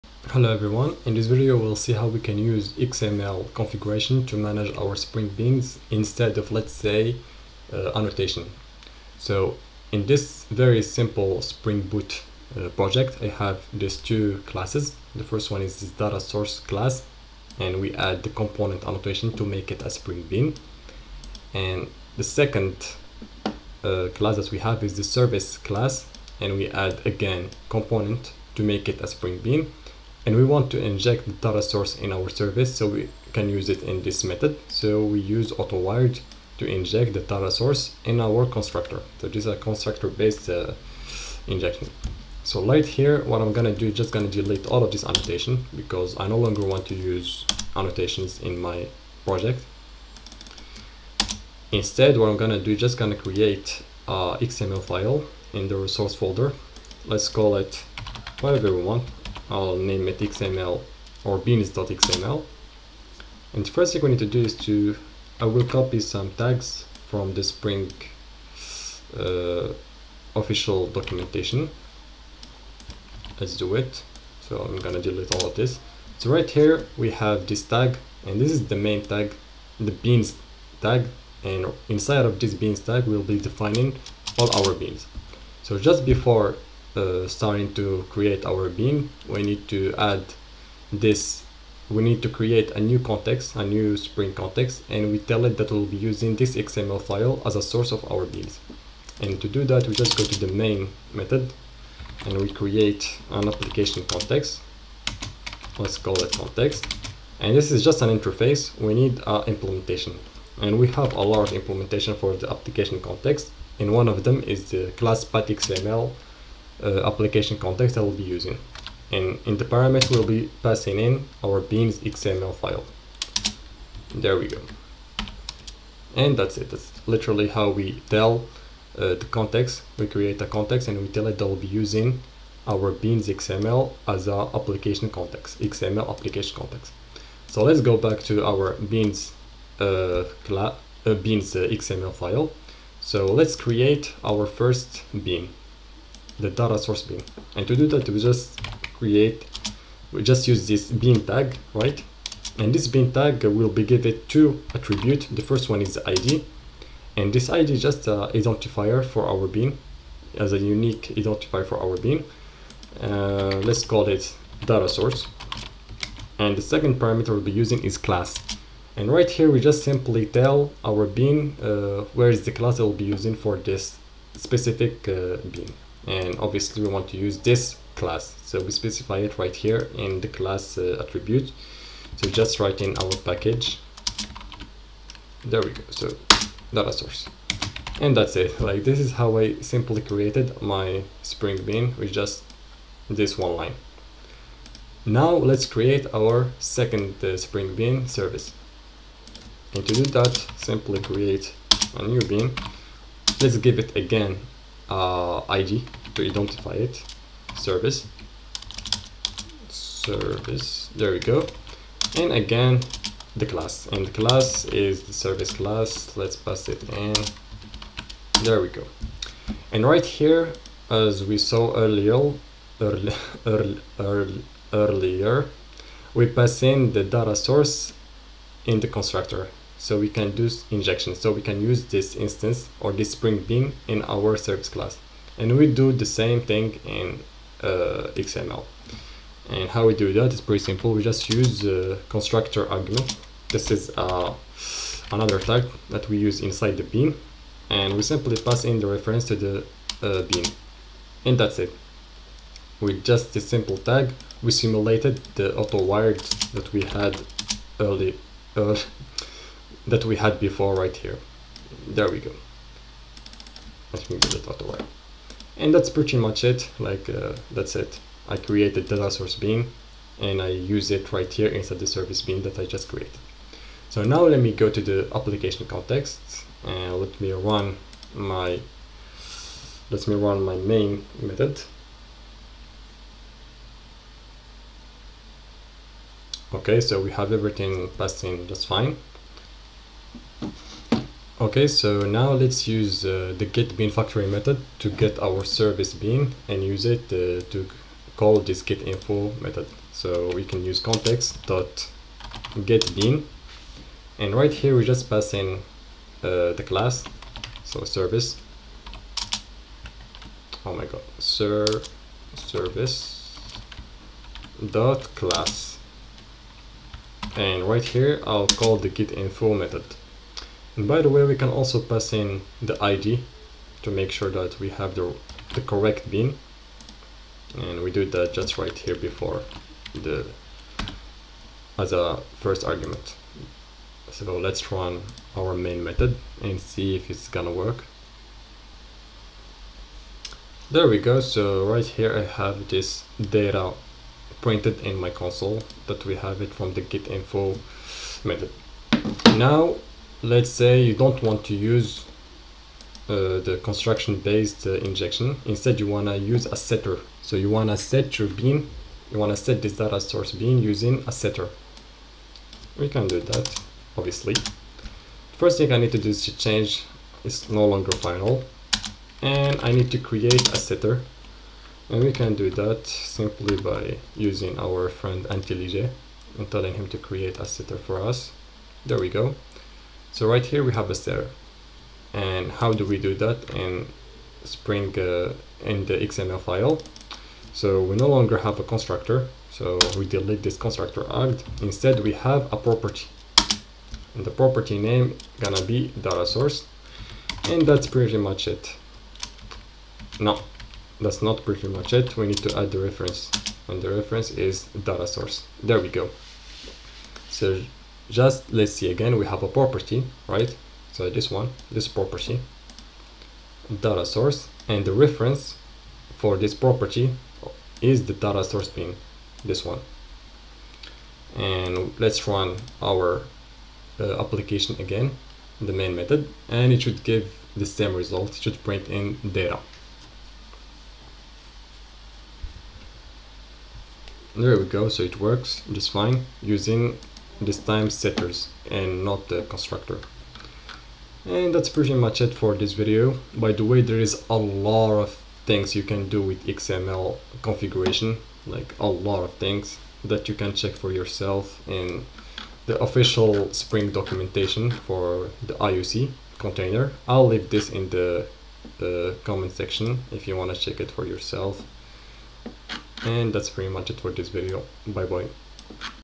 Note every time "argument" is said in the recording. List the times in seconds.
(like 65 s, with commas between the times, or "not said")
242 s, 332 s.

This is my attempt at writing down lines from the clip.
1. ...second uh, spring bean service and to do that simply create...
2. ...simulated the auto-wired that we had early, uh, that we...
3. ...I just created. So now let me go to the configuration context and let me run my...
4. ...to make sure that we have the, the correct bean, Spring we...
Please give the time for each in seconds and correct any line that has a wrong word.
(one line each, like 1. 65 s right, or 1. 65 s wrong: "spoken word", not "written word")
1. 196 s right
2. 254 s right
3. 272 s wrong: "application", not "configuration"
4. 323 s wrong: "And", not "Spring".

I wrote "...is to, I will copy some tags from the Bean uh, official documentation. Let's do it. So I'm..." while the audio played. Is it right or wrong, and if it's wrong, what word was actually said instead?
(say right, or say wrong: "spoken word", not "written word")
wrong: "Spring", not "Bean".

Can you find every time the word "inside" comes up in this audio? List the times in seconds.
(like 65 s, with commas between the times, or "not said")
81 s, 246 s, 271 s.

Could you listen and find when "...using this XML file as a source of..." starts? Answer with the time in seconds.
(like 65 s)
95 s.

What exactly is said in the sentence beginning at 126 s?
That's literally how we tell uh, the context.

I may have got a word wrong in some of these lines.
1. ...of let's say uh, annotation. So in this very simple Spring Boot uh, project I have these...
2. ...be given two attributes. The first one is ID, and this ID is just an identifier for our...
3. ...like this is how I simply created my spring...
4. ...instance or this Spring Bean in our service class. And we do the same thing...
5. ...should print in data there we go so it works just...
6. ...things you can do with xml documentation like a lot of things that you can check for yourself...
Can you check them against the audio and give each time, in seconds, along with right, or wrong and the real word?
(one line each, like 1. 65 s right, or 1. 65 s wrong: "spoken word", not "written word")
1. 6 s right
2. 153 s right
3. 188 s right
4. 232 s right
5. 428 s right
6. 445 s wrong: "configuration", not "documentation".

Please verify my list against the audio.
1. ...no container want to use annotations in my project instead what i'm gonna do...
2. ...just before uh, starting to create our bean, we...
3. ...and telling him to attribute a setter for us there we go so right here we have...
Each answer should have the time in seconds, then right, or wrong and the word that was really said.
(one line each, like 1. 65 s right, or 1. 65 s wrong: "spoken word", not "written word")
1. 46 s wrong: "longer", not "container"
2. 85 s right
3. 376 s wrong: "create", not "attribute".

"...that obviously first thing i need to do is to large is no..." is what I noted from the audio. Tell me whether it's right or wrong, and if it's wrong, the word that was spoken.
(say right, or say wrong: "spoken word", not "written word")
wrong: "change", not "large".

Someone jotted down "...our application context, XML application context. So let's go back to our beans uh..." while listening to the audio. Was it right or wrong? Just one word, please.
right.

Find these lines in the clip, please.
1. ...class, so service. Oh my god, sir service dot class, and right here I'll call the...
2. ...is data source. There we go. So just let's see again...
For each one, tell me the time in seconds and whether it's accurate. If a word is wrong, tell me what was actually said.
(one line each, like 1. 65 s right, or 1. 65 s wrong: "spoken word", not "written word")
1. 306 s right
2. 404 s right.